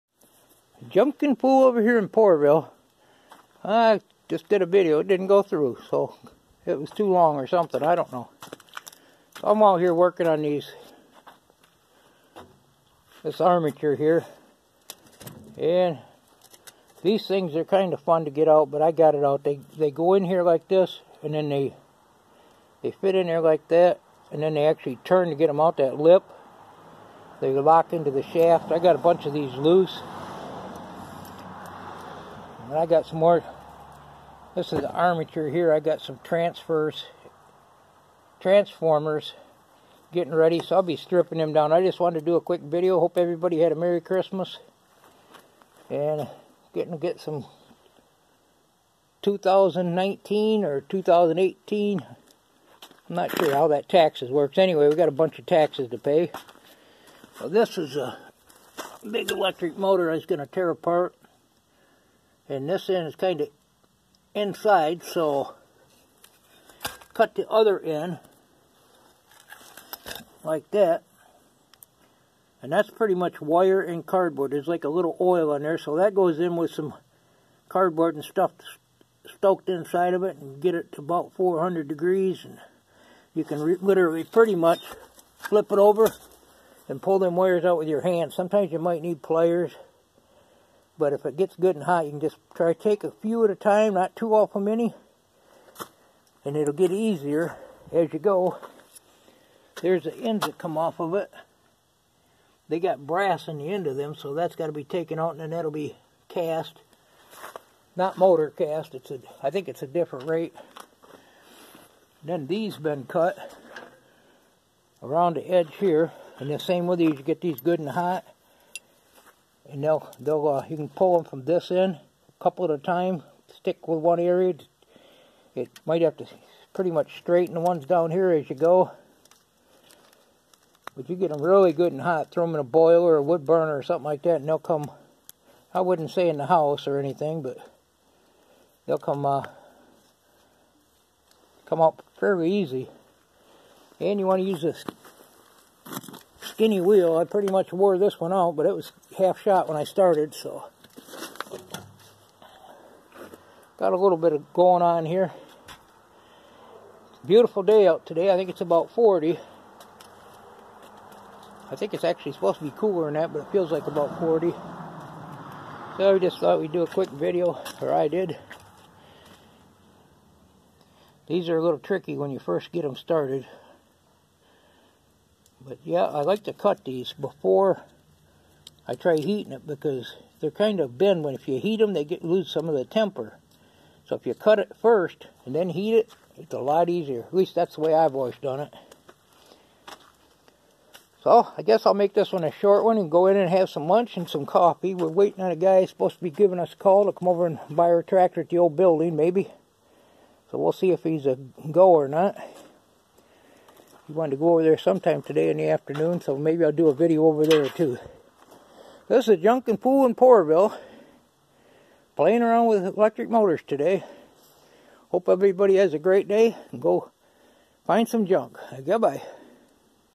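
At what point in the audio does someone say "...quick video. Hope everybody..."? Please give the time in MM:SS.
00:42.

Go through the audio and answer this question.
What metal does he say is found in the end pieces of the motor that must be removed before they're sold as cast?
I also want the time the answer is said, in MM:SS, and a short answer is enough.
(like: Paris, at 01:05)
brass, at 01:43.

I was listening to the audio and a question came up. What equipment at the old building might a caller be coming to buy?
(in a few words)
tractor.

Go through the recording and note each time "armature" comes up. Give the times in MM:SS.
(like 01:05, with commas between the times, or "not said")
00:13, 00:34.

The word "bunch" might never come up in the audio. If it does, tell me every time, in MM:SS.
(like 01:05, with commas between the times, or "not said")
00:28, 00:55.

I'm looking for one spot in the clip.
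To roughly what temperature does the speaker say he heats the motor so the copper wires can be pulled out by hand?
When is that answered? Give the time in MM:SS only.
01:21.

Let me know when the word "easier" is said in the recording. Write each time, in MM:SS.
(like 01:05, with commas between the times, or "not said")
01:36, 03:06.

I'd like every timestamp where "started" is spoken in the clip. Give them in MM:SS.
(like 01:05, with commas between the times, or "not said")
02:29, 02:52.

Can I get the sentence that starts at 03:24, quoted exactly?
He wanted to go over there sometime today in the afternoon, so maybe I'll do a video over there too.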